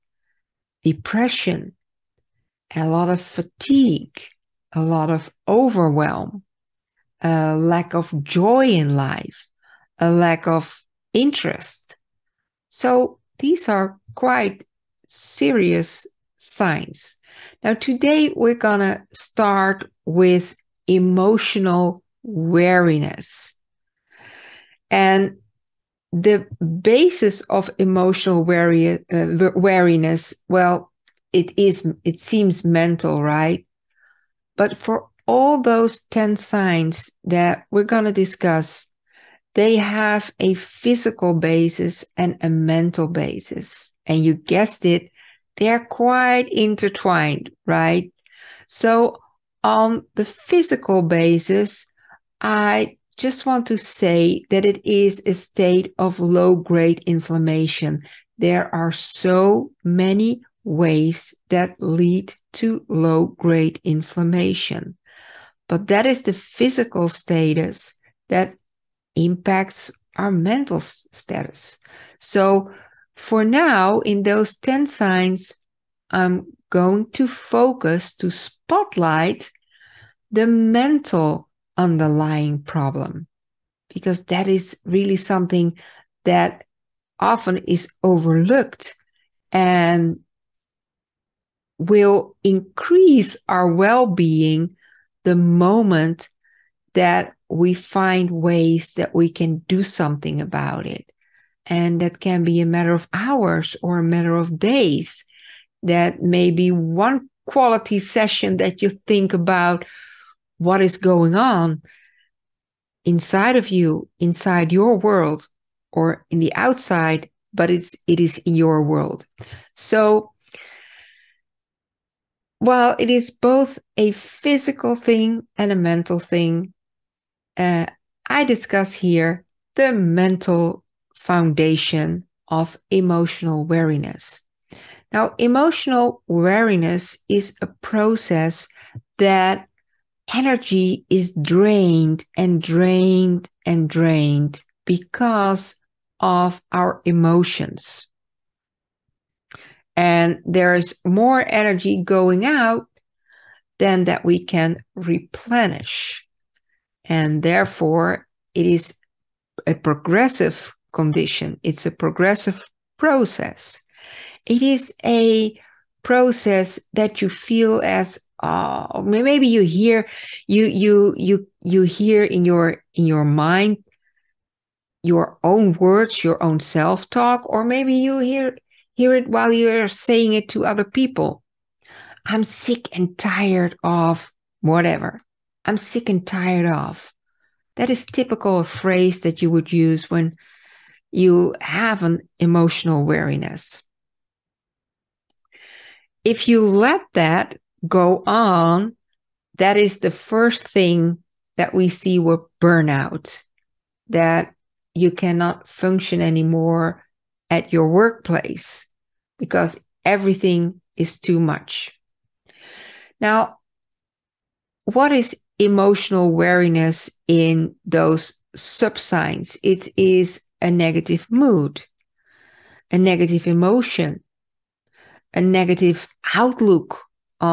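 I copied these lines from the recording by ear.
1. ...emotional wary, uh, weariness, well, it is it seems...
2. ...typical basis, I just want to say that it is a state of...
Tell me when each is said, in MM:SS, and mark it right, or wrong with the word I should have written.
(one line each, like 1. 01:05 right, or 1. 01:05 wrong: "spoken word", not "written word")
1. 00:27 wrong: "wariness", not "weariness"
2. 00:50 wrong: "physical", not "typical".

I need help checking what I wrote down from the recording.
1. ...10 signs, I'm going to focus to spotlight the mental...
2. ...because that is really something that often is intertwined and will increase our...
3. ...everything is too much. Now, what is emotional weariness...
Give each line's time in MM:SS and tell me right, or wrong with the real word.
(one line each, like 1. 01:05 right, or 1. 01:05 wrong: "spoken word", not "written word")
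1. 01:14 right
2. 01:23 wrong: "overlooked", not "intertwined"
3. 03:30 right.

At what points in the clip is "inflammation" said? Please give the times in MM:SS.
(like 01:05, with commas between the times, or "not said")
00:57, 01:03.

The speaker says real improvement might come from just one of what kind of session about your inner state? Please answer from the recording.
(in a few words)
quality session.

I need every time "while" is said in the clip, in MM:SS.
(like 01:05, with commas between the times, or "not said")
02:02, 02:59.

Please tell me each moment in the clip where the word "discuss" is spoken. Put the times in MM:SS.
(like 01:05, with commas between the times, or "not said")
00:38, 02:08.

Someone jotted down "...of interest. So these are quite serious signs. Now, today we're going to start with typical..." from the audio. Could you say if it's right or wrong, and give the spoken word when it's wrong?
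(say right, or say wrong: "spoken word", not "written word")
wrong: "emotional", not "typical".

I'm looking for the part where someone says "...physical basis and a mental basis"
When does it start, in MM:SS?
00:40.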